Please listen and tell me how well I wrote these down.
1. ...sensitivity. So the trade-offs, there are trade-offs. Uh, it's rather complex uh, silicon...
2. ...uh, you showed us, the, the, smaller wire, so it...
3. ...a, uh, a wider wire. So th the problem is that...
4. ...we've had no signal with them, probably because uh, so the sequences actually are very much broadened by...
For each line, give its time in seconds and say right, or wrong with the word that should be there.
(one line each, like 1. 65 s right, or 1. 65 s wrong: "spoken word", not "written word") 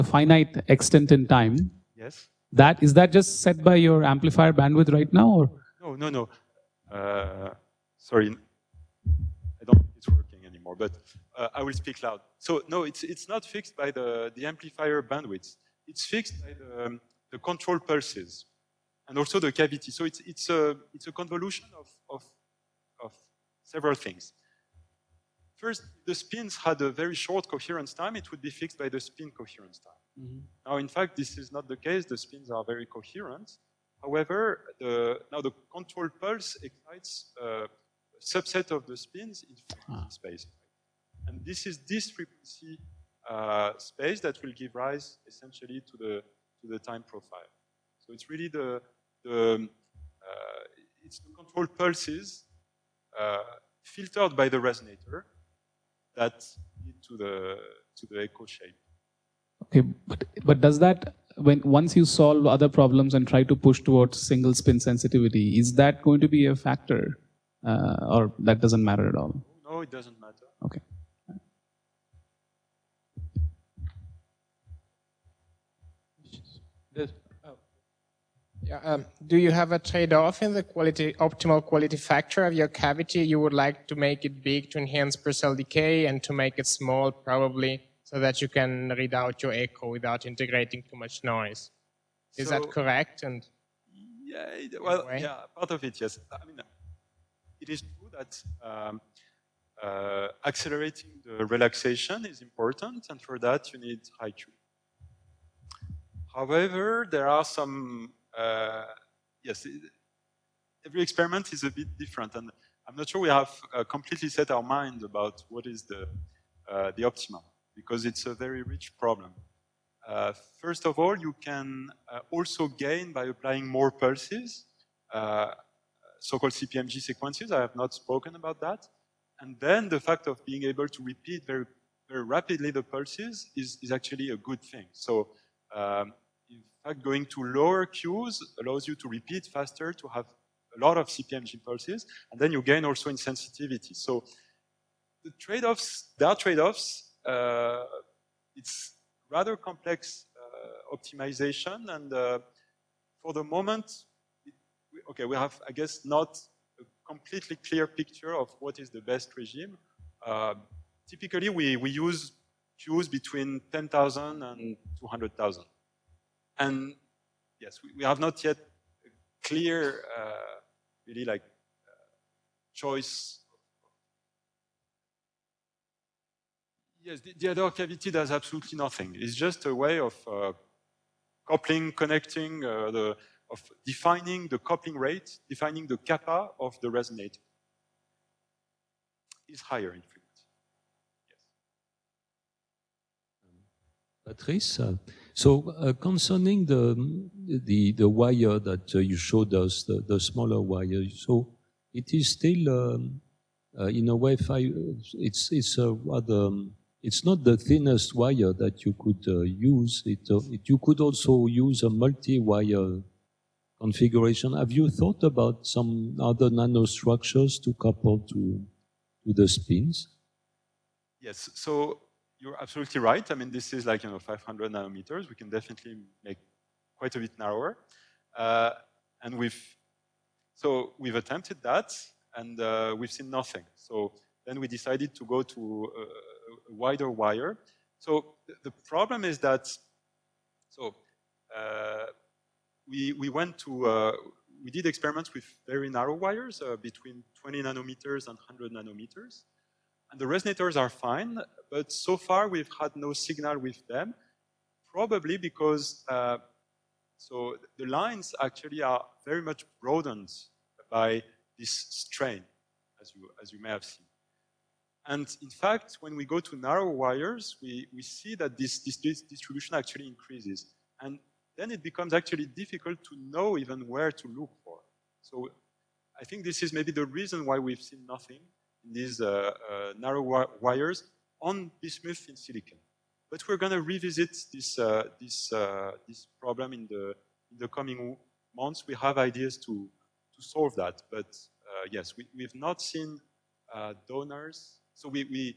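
1. 143 s wrong: "optimization", not "silicon"
2. 198 s right
3. 235 s right
4. 252 s wrong: "lines", not "sequences".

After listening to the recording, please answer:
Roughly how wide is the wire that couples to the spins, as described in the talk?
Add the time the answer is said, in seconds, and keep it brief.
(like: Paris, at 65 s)
500 nanometers, at 224 s.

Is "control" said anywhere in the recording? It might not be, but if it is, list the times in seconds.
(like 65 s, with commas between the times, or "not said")
17 s, 35 s, 51 s.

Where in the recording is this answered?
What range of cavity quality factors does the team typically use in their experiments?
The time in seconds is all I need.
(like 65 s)
163 s.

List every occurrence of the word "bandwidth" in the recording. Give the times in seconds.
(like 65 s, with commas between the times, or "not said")
4 s, 15 s.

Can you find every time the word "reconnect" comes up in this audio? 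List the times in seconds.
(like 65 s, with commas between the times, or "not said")
not said.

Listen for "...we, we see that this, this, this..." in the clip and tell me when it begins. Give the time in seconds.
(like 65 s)
267 s.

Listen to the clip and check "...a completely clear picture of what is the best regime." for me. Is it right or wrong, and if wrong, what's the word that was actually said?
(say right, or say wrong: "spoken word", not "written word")
right.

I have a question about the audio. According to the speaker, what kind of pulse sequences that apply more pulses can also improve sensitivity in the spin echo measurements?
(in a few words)
CPMG sequences.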